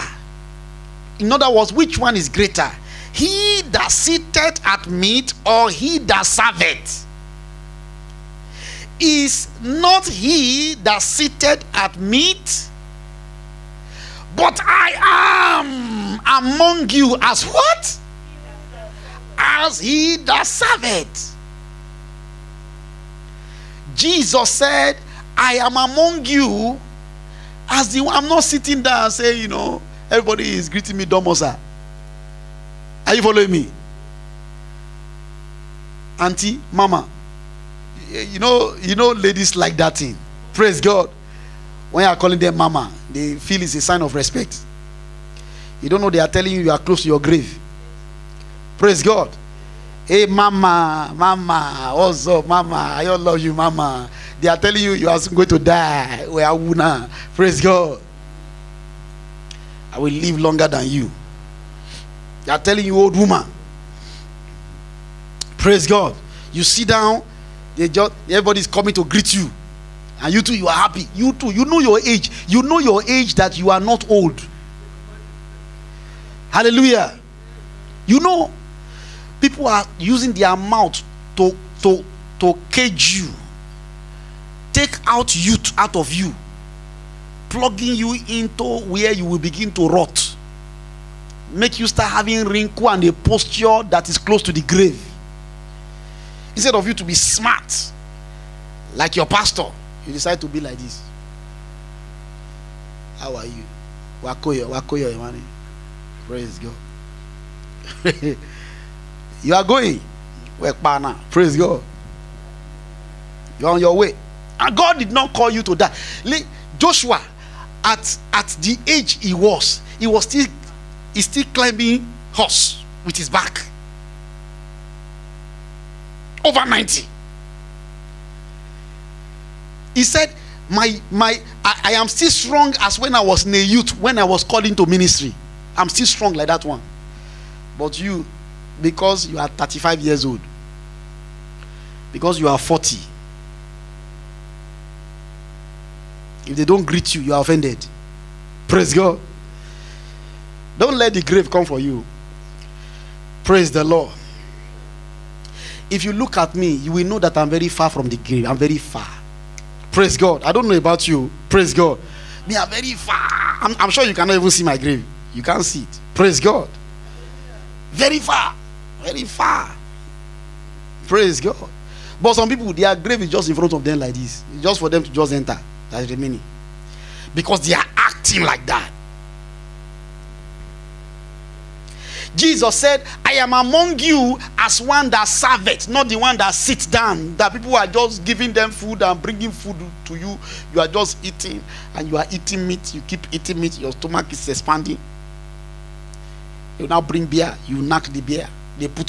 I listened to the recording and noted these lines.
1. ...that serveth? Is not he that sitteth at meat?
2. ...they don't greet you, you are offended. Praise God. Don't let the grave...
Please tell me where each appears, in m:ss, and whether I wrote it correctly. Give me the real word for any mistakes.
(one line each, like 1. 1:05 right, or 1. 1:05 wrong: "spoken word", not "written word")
1. 0:05 right
2. 2:26 right.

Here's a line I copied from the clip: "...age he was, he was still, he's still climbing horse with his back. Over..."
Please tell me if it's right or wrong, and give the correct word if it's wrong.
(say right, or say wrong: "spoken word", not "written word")
right.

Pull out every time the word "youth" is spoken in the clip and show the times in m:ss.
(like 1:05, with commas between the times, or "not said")
1:25, 2:13.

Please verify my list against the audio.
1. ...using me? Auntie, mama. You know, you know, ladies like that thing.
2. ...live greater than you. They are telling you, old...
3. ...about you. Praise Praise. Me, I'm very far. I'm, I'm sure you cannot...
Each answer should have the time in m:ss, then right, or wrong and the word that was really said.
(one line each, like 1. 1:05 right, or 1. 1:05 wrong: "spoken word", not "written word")
1. 0:33 wrong: "following", not "using"
2. 1:00 wrong: "longer", not "greater"
3. 2:40 wrong: "God", not "Praise".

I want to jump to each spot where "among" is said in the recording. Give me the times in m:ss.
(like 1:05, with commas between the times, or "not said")
0:16, 0:25, 3:03.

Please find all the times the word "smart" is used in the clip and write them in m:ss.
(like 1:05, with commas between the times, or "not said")
1:37.